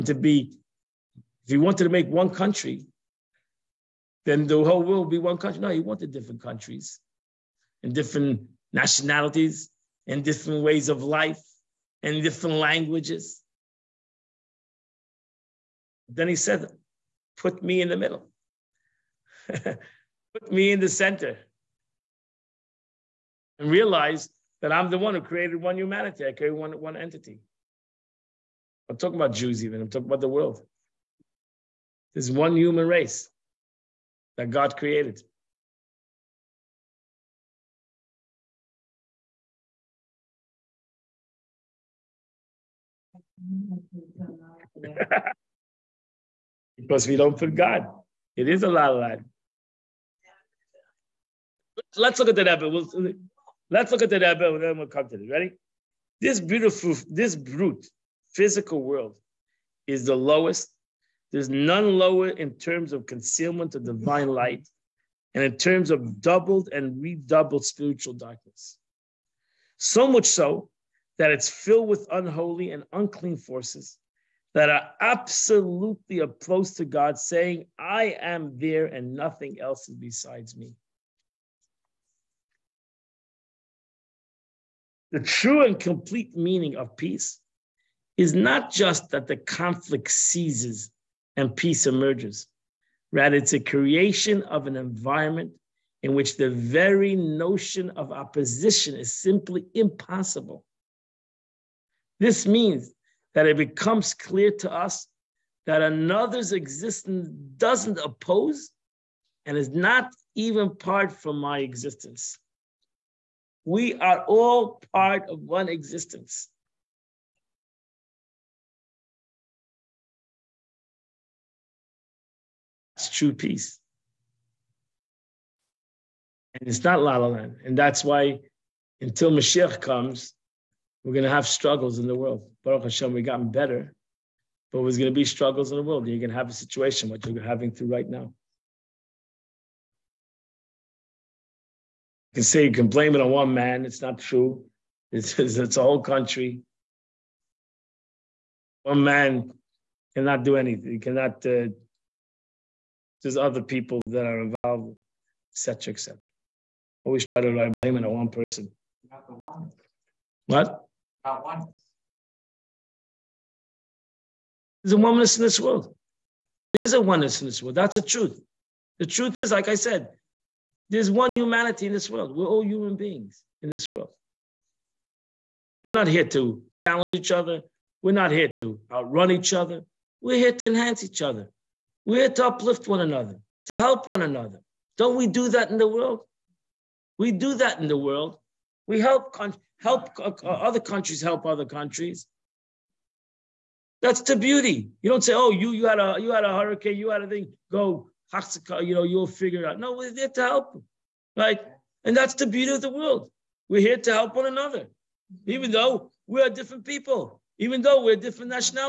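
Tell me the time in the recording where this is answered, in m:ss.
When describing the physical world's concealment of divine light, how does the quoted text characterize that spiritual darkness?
1:06.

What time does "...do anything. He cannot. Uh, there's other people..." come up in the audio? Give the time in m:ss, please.
2:30.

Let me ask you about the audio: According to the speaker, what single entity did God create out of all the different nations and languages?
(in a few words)
one human race.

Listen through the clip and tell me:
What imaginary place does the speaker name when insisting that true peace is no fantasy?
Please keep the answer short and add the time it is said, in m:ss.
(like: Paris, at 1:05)
La La Land, at 2:07.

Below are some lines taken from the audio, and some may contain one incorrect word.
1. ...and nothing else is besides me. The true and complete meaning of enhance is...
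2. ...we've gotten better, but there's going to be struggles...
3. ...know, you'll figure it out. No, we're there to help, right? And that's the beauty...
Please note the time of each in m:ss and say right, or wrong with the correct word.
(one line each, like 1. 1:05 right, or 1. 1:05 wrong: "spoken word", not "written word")
1. 1:18 wrong: "peace", not "enhance"
2. 2:13 right
3. 3:18 right.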